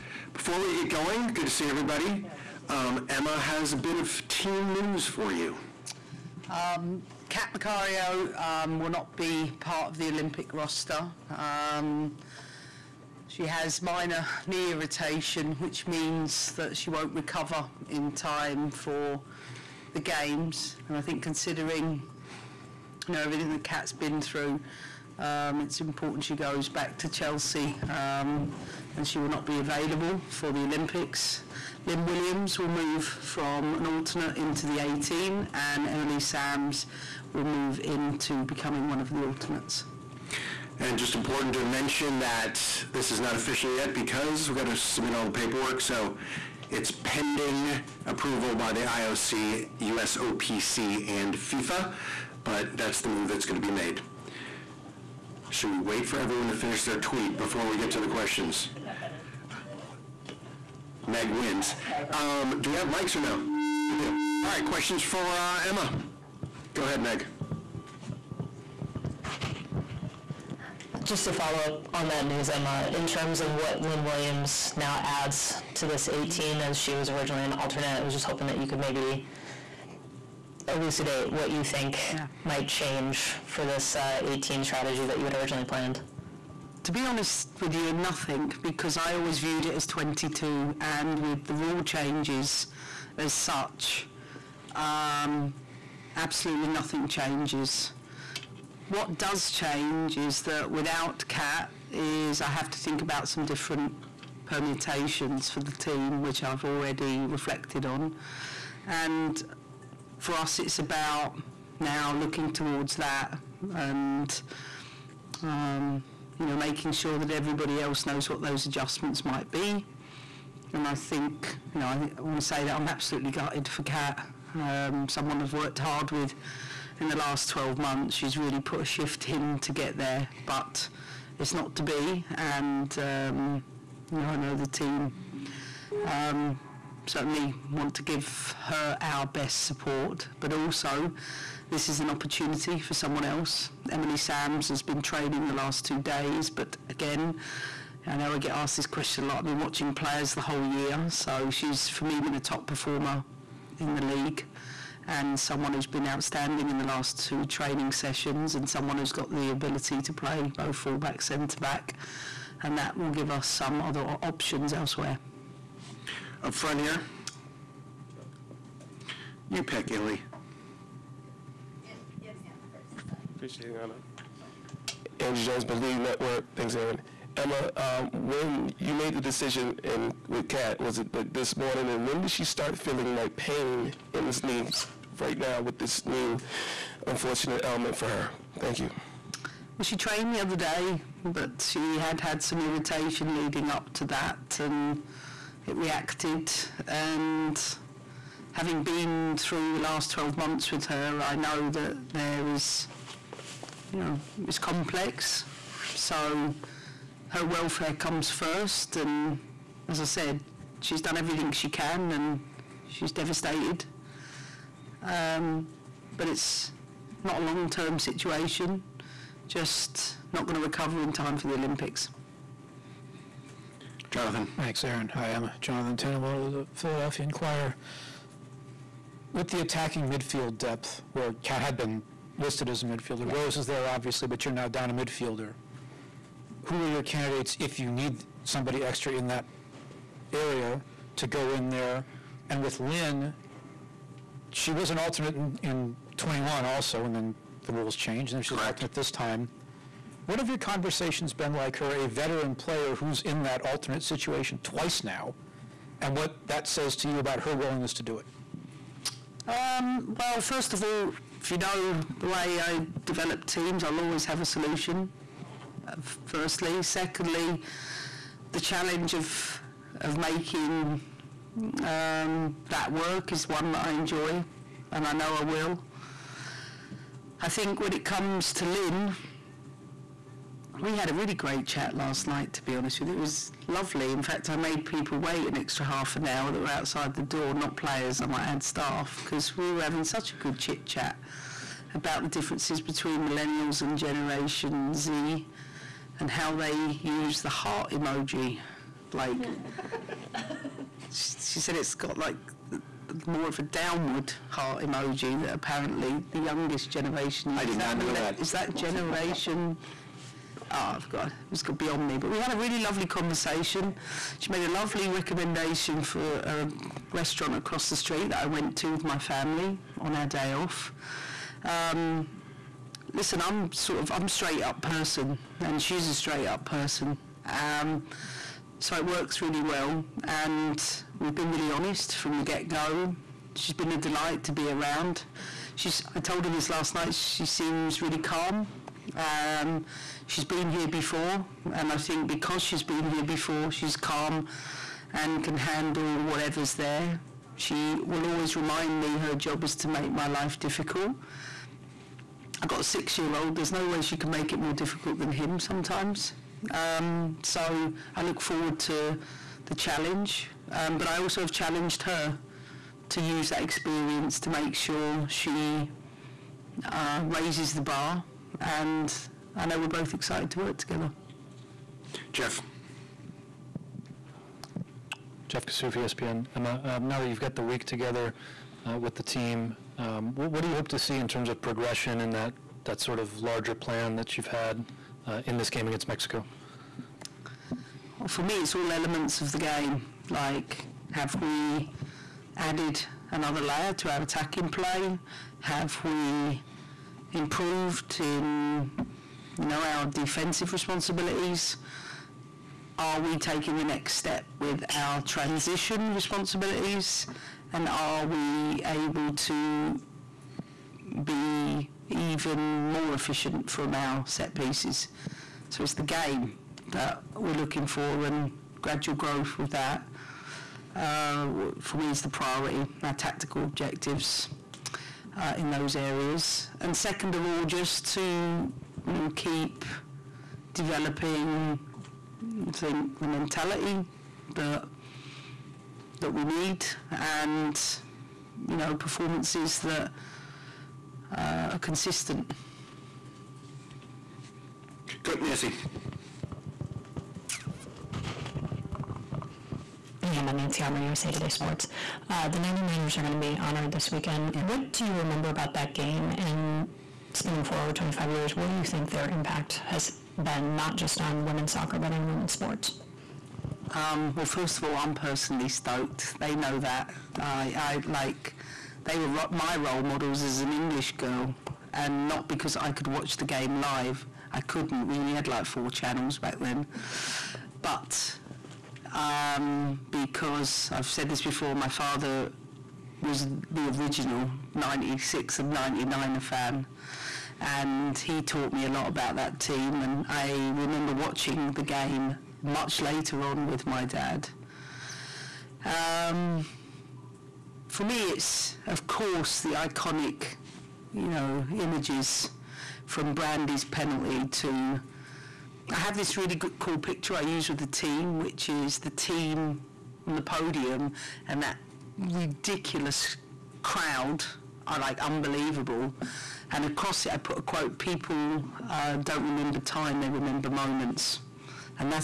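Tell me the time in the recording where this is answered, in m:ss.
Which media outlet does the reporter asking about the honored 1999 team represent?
7:30.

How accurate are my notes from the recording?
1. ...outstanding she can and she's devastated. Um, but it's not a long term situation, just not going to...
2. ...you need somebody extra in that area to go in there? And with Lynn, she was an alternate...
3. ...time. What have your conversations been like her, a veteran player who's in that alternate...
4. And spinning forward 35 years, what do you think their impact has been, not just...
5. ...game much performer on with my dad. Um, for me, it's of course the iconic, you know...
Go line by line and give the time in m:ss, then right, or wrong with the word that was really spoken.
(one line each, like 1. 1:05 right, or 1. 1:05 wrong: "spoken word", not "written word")
1. 3:31 wrong: "everything", not "outstanding"
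2. 3:57 right
3. 4:09 right
4. 7:36 wrong: "25", not "35"
5. 8:11 wrong: "later", not "performer".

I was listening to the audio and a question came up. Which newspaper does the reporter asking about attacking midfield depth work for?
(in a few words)
Philadelphia Inquirer.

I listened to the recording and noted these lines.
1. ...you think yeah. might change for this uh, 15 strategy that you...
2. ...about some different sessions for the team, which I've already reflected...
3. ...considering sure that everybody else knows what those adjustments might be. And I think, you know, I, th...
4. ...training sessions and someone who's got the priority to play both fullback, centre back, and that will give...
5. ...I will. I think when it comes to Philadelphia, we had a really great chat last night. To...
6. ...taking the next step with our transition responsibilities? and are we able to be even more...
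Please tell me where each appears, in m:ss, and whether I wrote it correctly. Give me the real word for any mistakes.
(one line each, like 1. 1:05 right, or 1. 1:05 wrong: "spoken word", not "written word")
1. 1:21 wrong: "18", not "15"
2. 1:43 wrong: "permutations", not "sessions"
3. 1:56 wrong: "making", not "considering"
4. 2:37 wrong: "ability", not "priority"
5. 4:35 wrong: "Lynn", not "Philadelphia"
6. 6:43 right.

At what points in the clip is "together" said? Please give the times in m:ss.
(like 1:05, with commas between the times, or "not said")
6:10, 6:17.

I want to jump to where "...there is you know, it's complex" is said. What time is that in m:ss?
3:22.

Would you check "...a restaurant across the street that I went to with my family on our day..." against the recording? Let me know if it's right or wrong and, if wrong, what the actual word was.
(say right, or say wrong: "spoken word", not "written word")
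right.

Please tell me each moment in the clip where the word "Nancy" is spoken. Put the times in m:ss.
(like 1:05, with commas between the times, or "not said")
7:25, 7:30.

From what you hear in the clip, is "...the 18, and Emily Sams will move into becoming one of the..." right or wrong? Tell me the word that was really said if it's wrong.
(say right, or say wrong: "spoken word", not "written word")
right.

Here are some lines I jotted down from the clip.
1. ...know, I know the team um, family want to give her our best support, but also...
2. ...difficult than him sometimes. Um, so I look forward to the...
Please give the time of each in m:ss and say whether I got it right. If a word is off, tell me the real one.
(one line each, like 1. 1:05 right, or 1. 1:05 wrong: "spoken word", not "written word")
1. 2:14 wrong: "certainly", not "family"
2. 5:54 right.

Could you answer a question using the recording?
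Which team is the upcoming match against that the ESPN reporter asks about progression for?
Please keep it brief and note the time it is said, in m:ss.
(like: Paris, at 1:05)
Mexico, at 6:26.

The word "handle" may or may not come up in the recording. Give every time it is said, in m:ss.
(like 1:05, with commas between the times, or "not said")
5:45.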